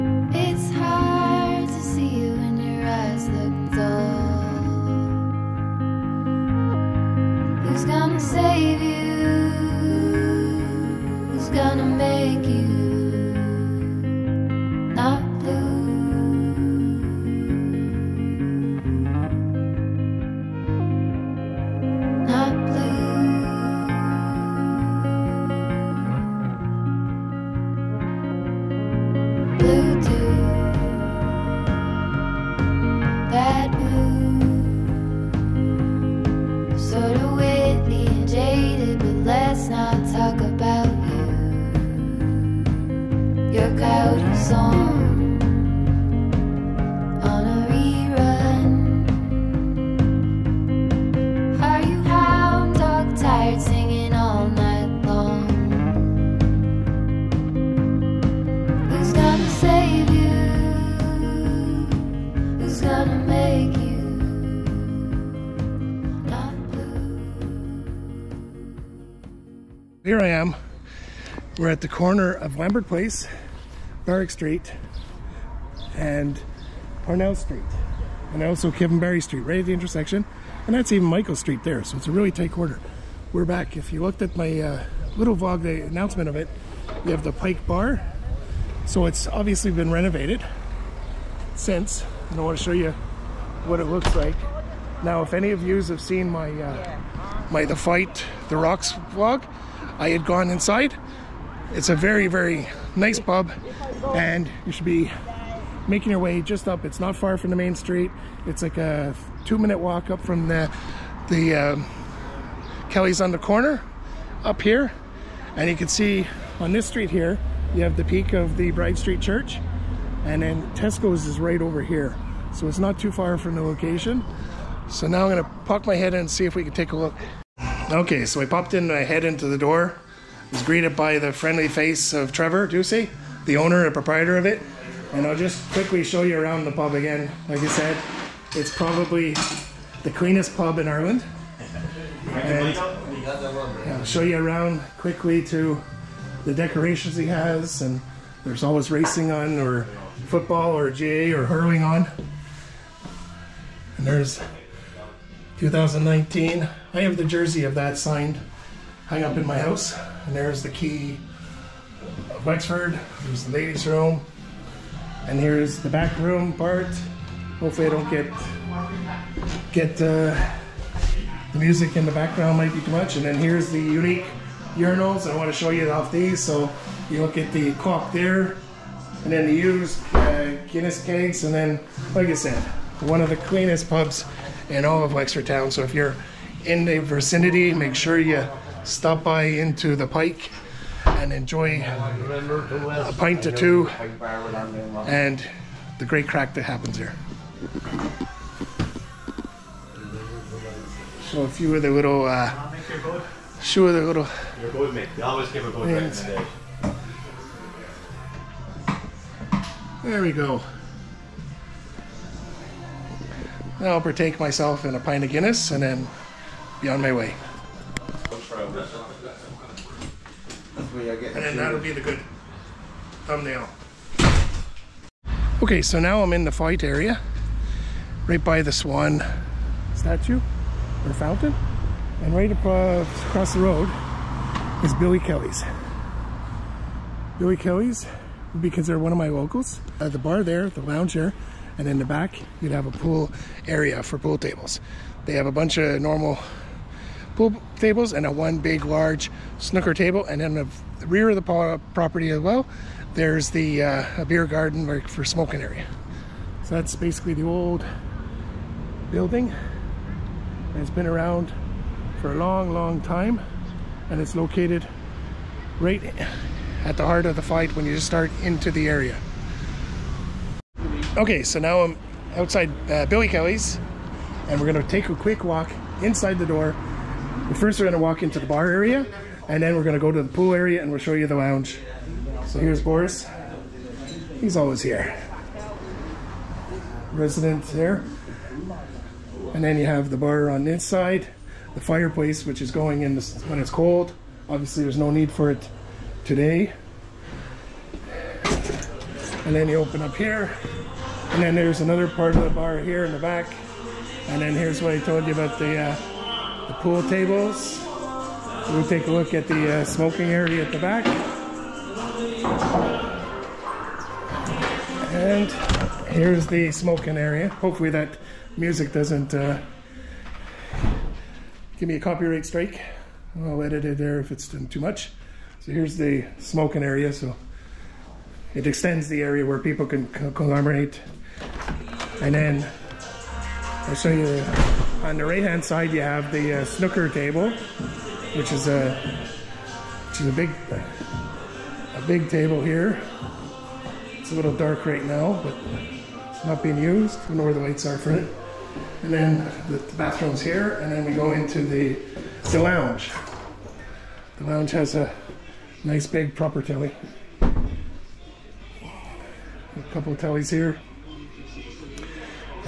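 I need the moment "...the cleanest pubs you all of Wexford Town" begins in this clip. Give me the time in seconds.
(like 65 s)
183 s.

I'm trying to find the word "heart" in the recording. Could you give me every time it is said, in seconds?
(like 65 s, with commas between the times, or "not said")
267 s.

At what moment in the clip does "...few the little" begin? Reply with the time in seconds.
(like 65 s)
203 s.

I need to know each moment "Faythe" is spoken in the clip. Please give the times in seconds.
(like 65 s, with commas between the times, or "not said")
97 s, 226 s, 267 s.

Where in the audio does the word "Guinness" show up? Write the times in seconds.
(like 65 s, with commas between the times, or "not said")
180 s, 215 s.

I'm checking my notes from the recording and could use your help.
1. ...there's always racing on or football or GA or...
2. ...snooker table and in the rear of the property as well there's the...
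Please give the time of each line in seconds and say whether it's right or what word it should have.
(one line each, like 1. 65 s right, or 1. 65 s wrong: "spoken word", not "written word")
1. 148 s right
2. 249 s right.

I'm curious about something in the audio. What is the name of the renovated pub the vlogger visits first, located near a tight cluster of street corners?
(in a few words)
The Pike Bar.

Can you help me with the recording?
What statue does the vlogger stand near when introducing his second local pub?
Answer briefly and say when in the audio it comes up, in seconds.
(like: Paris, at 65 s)
Swan statue, at 228 s.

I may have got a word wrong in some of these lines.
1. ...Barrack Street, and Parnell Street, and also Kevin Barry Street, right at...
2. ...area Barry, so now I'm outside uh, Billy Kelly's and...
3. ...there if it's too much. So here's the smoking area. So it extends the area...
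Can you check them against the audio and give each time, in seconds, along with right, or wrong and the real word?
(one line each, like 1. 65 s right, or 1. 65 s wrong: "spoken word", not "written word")
1. 74 s right
2. 268 s wrong: "Okay", not "Barry"
3. 323 s right.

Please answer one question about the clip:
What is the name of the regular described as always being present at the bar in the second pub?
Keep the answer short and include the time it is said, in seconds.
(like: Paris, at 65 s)
Boris, at 282 s.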